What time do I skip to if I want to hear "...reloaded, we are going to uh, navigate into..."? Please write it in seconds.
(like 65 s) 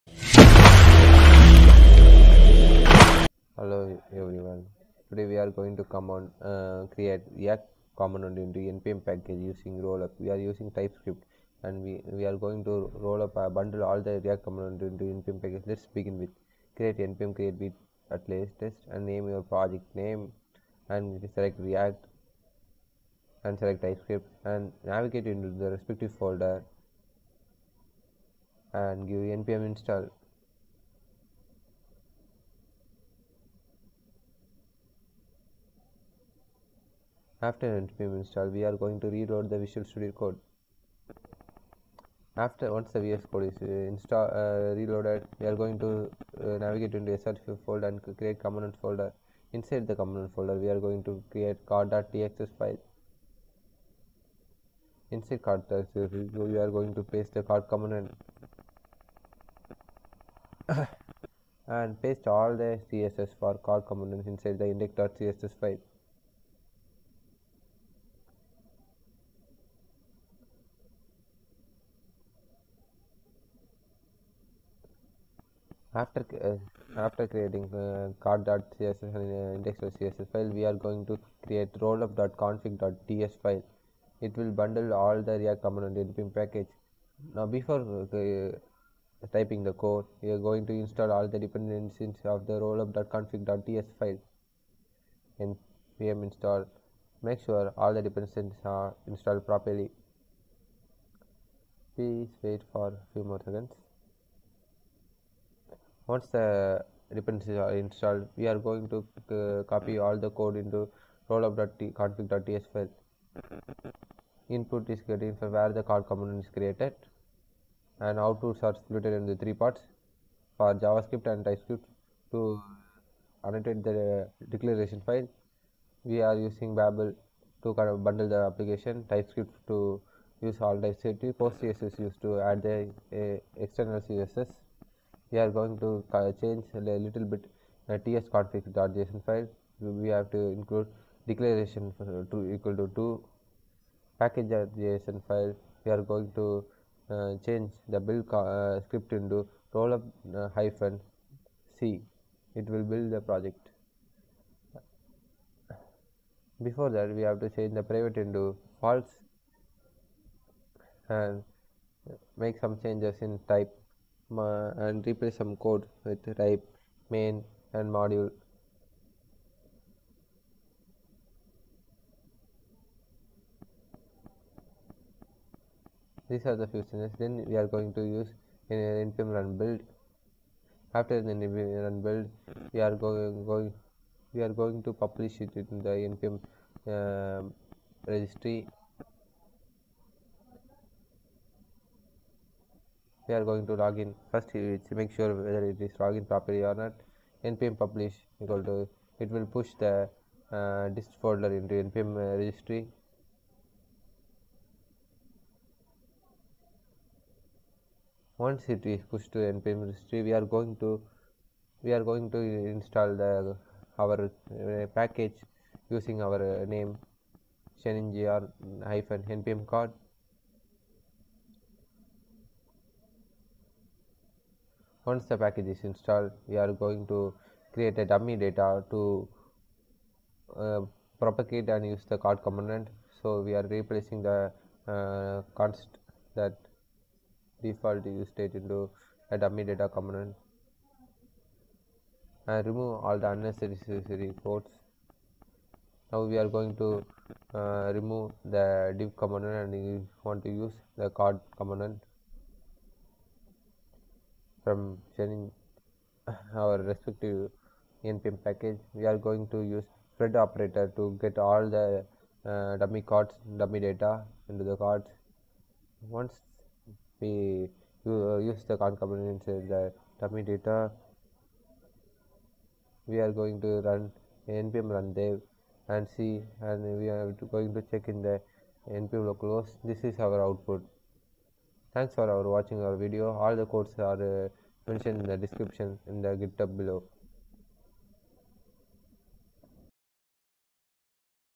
44 s.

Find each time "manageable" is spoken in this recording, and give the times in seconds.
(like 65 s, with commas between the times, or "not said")
not said.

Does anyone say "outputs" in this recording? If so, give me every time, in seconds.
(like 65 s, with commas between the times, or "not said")
118 s, 280 s.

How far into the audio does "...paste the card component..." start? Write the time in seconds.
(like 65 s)
57 s.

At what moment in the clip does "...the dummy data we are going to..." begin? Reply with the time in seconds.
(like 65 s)
269 s.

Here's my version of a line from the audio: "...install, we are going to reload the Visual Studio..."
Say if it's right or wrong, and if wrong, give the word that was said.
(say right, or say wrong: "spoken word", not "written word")
right.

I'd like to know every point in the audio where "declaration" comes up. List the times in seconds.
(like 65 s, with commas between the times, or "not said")
124 s, 141 s.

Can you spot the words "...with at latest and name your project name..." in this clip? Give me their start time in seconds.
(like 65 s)
17 s.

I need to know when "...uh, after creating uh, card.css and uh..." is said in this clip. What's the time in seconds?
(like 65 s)
76 s.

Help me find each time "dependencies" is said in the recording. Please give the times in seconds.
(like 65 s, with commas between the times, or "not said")
91 s, 98 s, 107 s.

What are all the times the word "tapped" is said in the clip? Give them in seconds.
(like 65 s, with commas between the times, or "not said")
not said.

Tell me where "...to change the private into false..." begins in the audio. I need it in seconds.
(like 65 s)
157 s.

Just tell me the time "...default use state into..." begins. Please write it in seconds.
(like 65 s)
237 s.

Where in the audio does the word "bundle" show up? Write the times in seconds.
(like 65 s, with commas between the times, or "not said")
13 s, 84 s, 128 s.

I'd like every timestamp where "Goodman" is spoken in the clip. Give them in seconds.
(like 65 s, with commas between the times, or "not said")
not said.